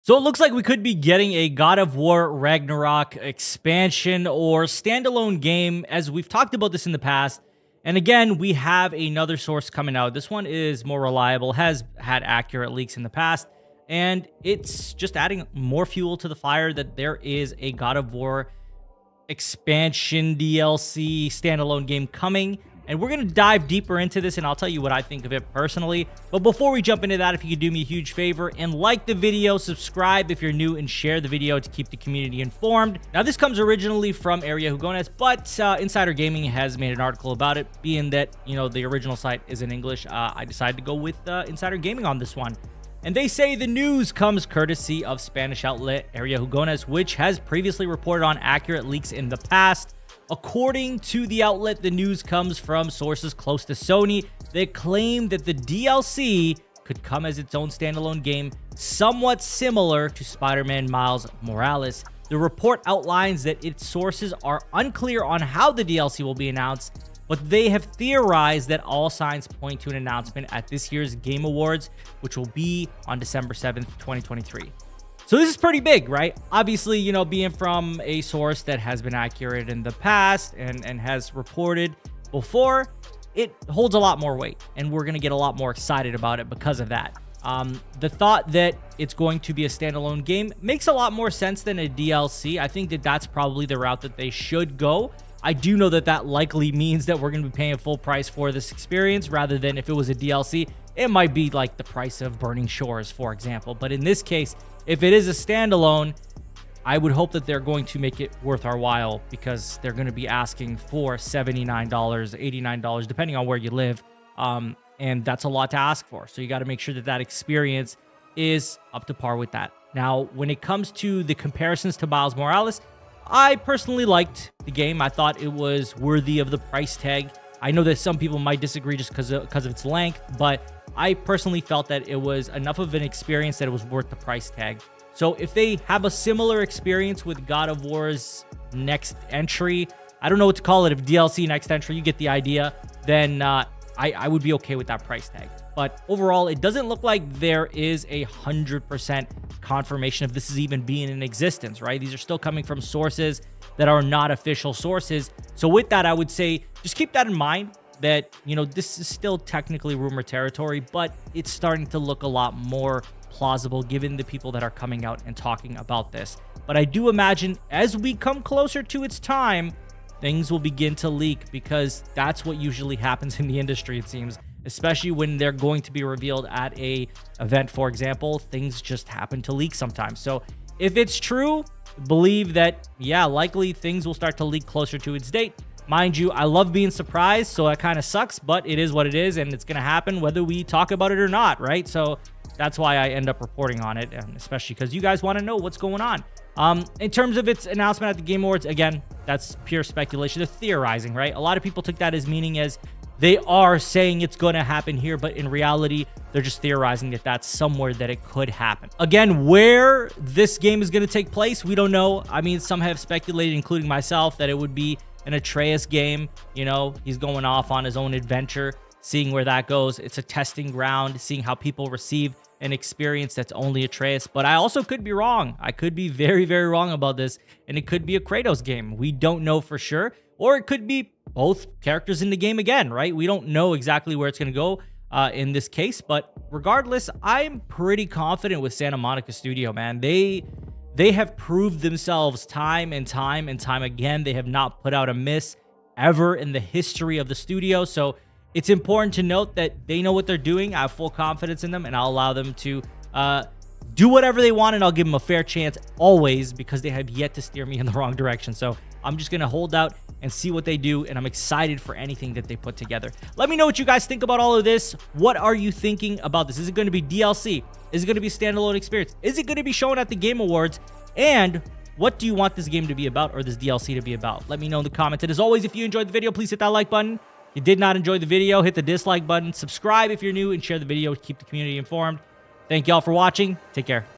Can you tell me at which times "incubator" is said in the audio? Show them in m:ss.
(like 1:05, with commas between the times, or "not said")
not said.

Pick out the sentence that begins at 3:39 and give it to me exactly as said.
It's a testing ground, seeing how people receive an experience that's only Atreus.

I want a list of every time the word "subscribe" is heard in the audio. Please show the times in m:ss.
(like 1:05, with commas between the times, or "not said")
0:29, 4:39.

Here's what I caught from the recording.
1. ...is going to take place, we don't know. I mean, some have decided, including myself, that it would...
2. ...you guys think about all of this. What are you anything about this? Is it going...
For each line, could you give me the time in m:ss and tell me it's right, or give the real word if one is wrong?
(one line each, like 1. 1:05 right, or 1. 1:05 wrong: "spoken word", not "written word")
1. 3:30 wrong: "speculated", not "decided"
2. 4:23 wrong: "thinking", not "anything".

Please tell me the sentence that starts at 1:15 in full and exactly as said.
So this is pretty big, right?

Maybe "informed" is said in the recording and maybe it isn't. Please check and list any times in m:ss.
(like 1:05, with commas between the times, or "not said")
0:32, 4:41.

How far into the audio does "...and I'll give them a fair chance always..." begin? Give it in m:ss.
4:14.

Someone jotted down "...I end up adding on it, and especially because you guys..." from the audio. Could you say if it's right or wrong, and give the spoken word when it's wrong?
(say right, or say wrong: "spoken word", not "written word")
wrong: "reporting", not "adding".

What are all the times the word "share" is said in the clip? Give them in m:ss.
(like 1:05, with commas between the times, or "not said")
0:30, 4:40.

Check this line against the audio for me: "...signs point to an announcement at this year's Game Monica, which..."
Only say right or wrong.
wrong.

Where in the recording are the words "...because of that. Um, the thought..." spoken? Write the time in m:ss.
1:26.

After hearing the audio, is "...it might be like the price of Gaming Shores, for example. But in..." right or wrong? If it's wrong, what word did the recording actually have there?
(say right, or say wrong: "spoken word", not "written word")
wrong: "Burning", not "Gaming".